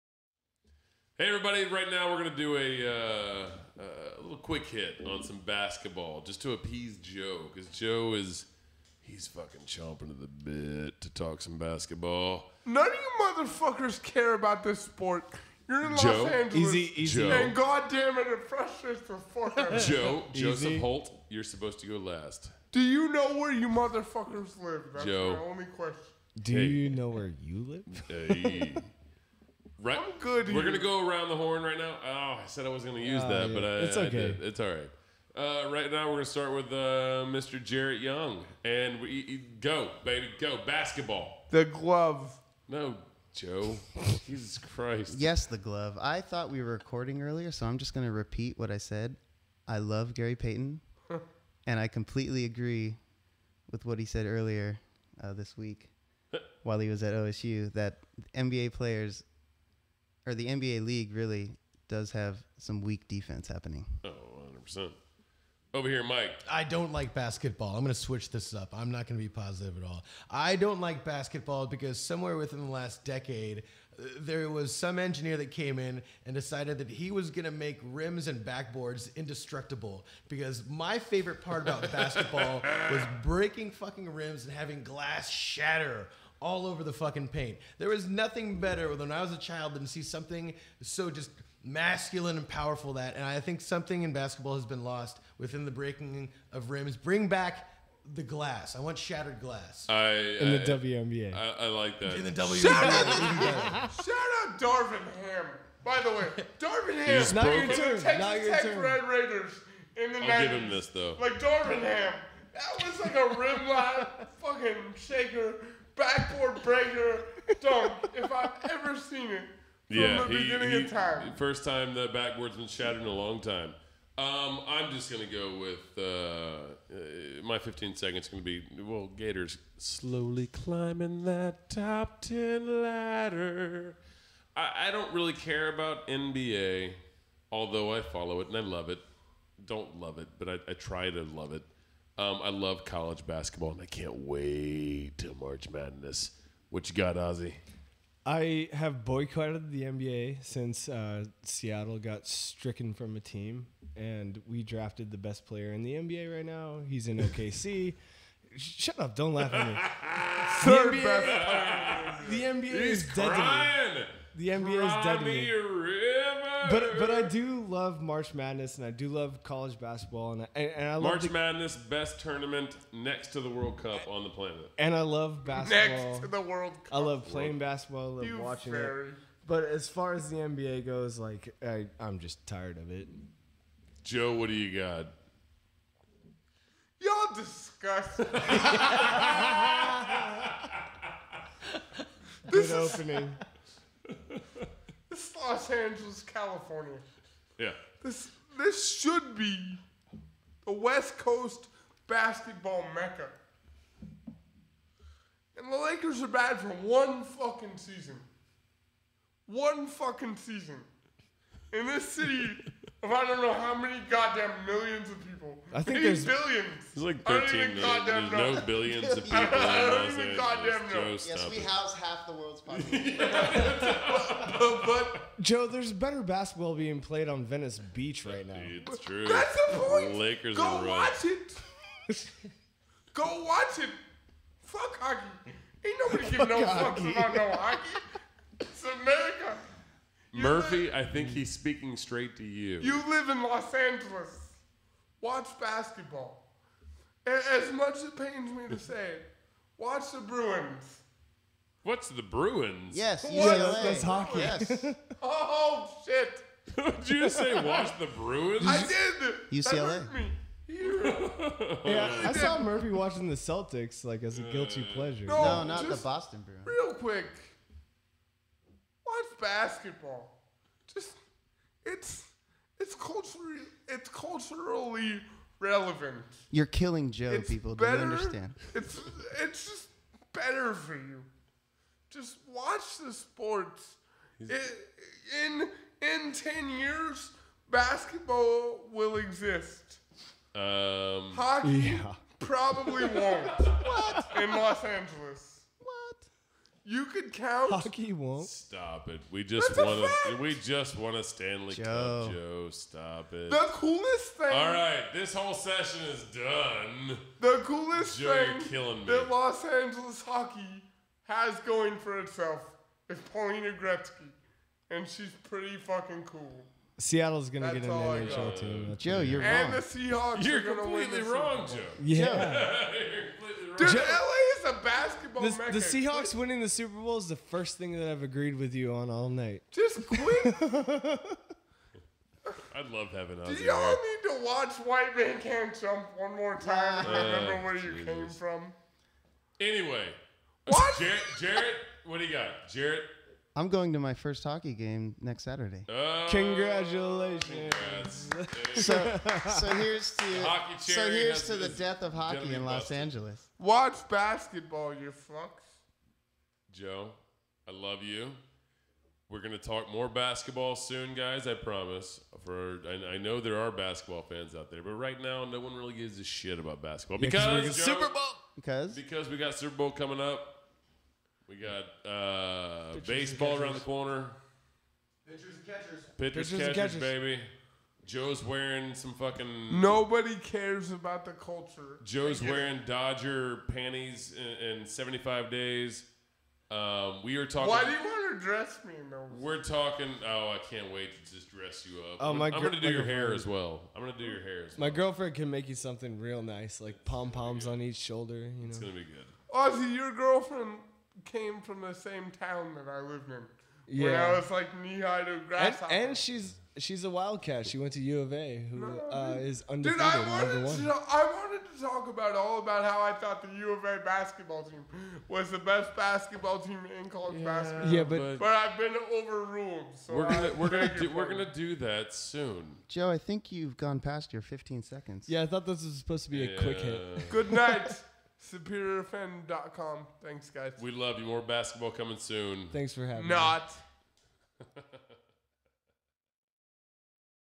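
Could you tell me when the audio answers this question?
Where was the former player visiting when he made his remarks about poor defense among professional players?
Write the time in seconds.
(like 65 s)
57 s.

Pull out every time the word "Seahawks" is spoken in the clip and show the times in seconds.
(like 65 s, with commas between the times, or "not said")
319 s, 325 s.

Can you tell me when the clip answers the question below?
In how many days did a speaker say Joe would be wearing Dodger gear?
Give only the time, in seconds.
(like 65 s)
384 s.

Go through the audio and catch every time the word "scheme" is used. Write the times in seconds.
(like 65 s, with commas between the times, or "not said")
not said.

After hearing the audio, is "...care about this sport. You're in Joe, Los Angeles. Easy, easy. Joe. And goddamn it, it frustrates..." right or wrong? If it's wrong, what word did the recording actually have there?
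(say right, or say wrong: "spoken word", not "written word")
right.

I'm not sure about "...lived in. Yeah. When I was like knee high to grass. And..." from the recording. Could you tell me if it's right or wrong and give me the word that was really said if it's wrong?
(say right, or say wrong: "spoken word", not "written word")
right.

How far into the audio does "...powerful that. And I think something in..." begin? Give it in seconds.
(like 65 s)
92 s.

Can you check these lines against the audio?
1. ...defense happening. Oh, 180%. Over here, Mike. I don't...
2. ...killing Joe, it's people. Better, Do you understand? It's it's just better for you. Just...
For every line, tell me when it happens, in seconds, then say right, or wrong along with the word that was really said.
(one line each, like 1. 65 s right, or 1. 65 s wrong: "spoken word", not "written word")
1. 63 s wrong: "100", not "180"
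2. 276 s right.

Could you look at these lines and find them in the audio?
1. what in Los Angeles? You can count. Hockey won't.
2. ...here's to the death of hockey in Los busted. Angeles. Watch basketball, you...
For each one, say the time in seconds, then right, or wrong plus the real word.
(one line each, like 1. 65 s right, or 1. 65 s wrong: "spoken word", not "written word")
1. 293 s right
2. 351 s right.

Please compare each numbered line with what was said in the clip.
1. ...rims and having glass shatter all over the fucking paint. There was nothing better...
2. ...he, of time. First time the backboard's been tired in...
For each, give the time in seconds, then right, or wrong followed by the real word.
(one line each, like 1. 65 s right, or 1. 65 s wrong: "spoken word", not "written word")
1. 84 s right
2. 120 s wrong: "shattered", not "tired".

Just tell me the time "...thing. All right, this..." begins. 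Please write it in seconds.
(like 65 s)
304 s.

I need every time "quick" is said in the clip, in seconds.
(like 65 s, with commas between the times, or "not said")
4 s, 266 s, 426 s.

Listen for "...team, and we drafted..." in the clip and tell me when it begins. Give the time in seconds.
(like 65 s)
153 s.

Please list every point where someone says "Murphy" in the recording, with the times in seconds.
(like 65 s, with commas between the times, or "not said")
240 s, 262 s.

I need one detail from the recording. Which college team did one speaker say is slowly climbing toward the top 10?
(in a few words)
Gators.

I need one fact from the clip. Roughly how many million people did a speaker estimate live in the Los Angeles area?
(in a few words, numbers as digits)
13 million.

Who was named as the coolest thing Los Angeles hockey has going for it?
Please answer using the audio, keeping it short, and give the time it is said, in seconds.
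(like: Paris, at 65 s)
Paulina Gretzky, at 313 s.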